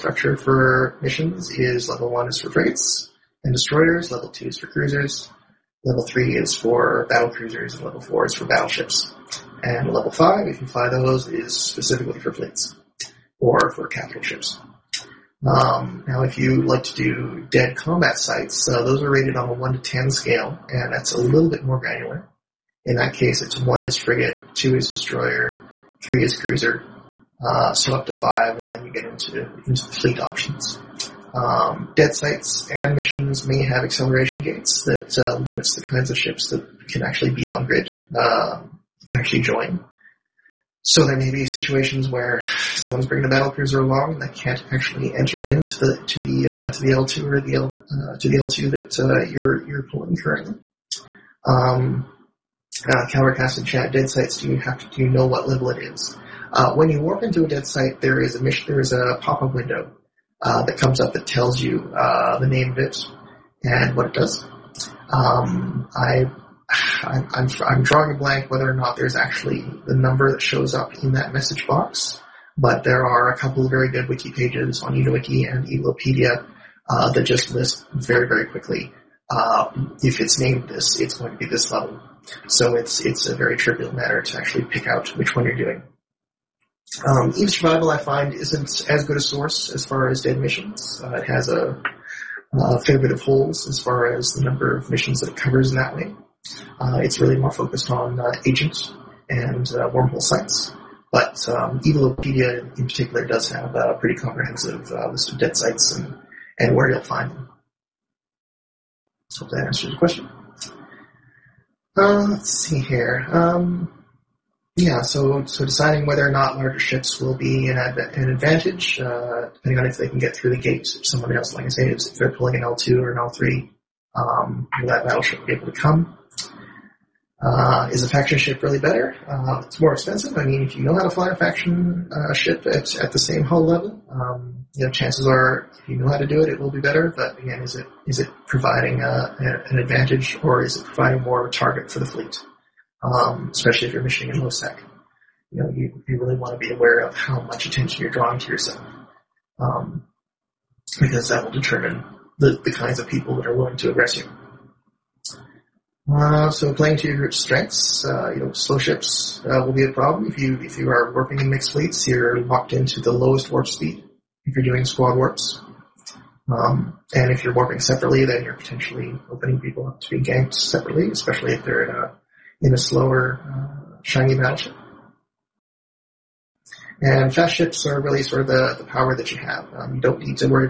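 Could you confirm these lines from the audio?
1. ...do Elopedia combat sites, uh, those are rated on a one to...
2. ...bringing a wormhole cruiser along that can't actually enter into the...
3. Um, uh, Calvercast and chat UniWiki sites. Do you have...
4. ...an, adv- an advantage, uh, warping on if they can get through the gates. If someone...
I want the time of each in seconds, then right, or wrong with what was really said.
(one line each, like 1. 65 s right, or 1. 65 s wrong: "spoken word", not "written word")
1. 16 s wrong: "DED", not "Elopedia"
2. 43 s wrong: "battle", not "wormhole"
3. 51 s wrong: "DED", not "UniWiki"
4. 117 s wrong: "depending", not "warping".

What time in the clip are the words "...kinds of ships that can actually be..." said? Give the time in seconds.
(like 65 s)
35 s.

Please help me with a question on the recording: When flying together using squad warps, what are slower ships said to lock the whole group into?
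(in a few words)
The lowest warp speed.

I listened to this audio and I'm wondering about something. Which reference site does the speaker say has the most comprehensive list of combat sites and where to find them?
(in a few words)
Evelopedia.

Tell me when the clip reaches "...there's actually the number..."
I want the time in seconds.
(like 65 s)
68 s.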